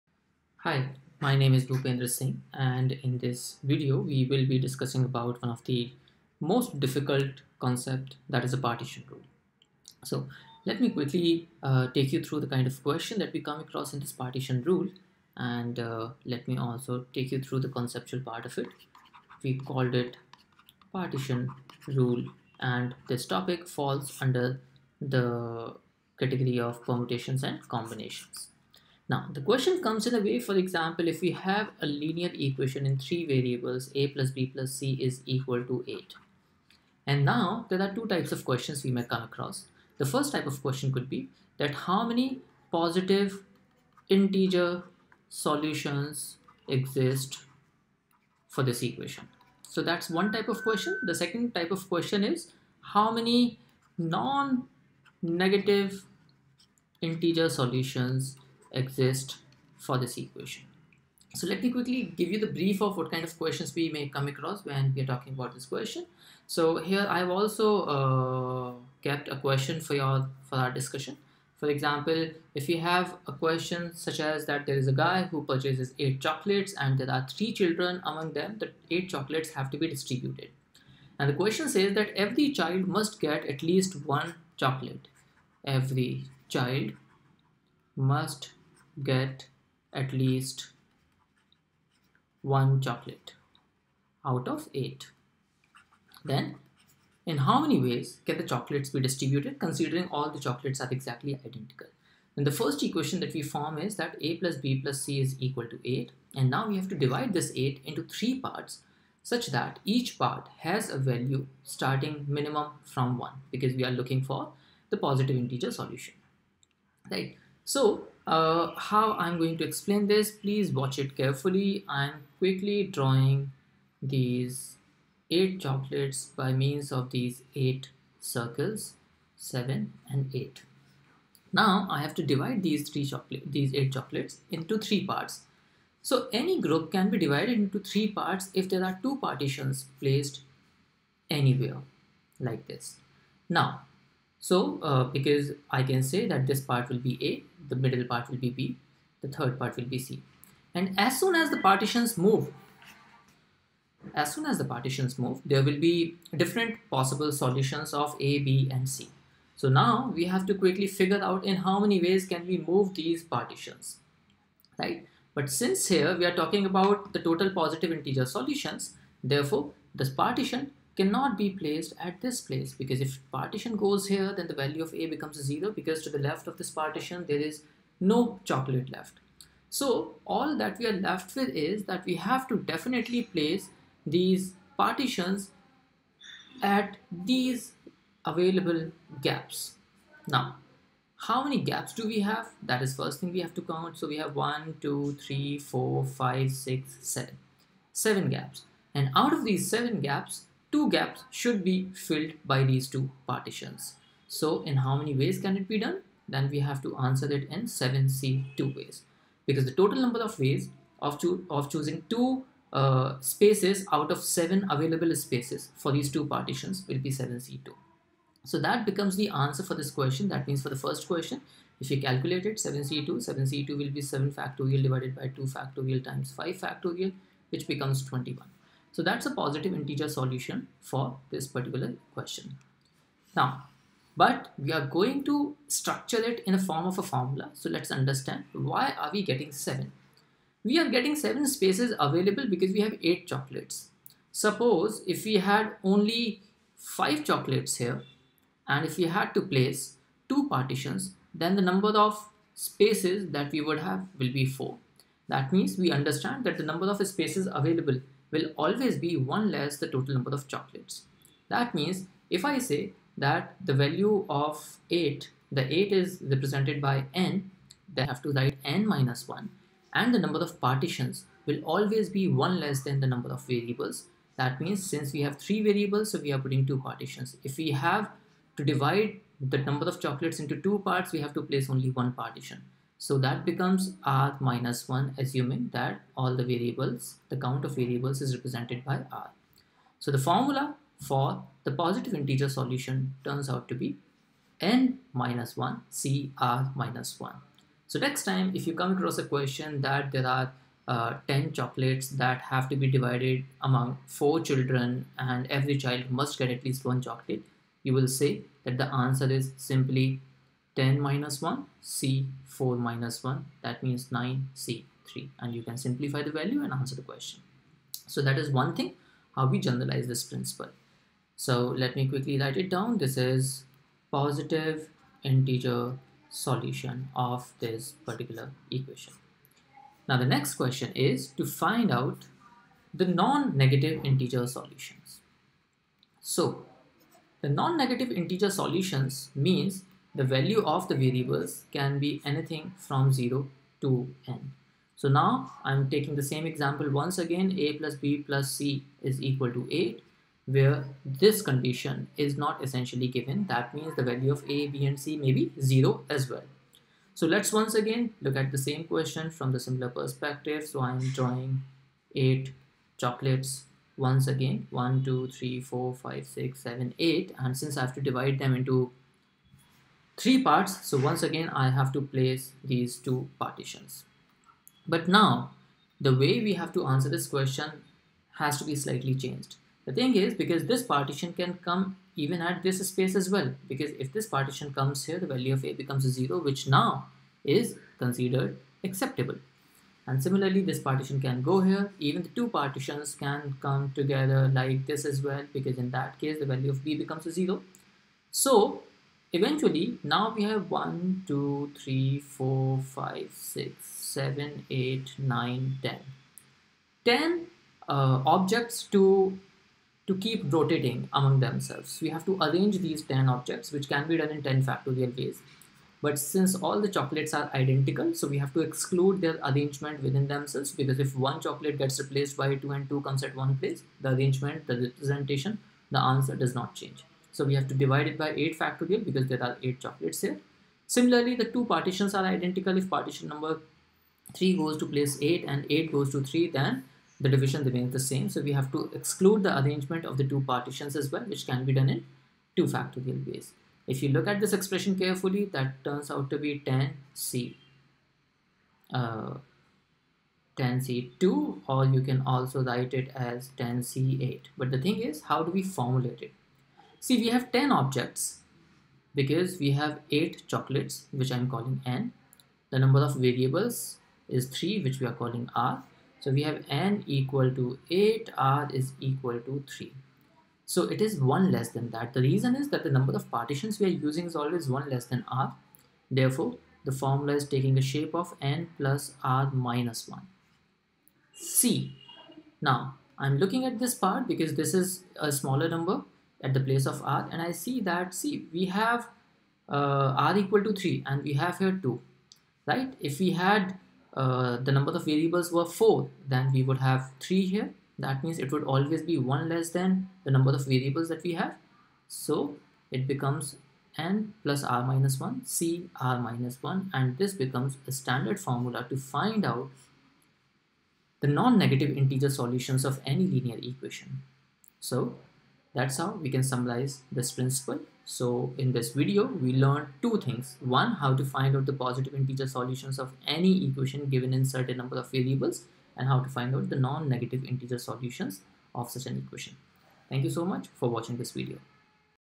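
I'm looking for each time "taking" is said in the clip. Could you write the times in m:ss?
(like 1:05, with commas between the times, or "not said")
5:45, 7:57.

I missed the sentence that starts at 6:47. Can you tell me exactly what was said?
10 uh, objects to, to keep rotating among themselves.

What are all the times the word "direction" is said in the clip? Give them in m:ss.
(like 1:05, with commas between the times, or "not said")
not said.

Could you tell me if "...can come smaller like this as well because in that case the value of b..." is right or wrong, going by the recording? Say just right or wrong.
wrong.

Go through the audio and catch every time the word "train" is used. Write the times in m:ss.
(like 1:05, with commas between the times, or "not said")
not said.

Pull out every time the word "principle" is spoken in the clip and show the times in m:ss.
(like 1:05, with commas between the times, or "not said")
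5:20, 8:37.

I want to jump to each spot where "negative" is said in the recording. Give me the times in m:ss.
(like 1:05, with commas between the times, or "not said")
0:53, 5:33, 5:37, 8:31, 8:46.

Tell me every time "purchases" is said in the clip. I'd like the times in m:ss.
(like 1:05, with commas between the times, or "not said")
1:15.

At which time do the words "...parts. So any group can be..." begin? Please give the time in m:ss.
2:15.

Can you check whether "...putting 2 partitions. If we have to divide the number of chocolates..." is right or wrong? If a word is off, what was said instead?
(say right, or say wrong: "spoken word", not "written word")
right.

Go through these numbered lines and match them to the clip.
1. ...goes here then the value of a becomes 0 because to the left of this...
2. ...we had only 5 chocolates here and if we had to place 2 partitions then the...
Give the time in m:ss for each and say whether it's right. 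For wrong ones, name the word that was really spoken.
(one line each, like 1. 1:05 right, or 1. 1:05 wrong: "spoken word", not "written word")
1. 2:53 right
2. 4:05 right.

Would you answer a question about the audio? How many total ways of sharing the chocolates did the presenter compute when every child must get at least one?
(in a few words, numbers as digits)
21.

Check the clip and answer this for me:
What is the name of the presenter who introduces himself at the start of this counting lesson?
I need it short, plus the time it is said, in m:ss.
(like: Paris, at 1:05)
Bhupendra Singh, at 0:01.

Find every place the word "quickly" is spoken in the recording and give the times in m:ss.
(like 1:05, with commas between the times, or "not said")
0:10, 1:01, 2:02, 2:40, 5:22.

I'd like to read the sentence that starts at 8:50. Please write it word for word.
Thank you so much for watching this video.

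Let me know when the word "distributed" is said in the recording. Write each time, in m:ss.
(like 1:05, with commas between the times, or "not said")
1:19, 1:38.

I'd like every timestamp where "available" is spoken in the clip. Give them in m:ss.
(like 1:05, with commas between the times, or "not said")
3:08, 3:34, 4:01, 4:17.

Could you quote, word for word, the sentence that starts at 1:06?
So here I've also uh, kept a question for your for our discussion.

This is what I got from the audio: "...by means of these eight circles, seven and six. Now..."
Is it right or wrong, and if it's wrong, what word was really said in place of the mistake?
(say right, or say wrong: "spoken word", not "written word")
wrong: "eight", not "six".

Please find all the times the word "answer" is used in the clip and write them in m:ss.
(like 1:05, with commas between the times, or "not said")
3:26, 3:39, 5:08, 5:16, 6:16, 7:06.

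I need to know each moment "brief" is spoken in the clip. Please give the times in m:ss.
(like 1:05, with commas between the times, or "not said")
1:02.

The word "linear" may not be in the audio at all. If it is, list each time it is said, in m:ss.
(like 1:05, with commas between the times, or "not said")
0:31, 8:33.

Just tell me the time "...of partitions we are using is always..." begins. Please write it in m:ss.
7:53.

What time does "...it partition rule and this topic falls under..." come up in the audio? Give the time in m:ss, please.
0:19.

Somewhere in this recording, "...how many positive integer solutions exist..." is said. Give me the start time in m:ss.
0:41.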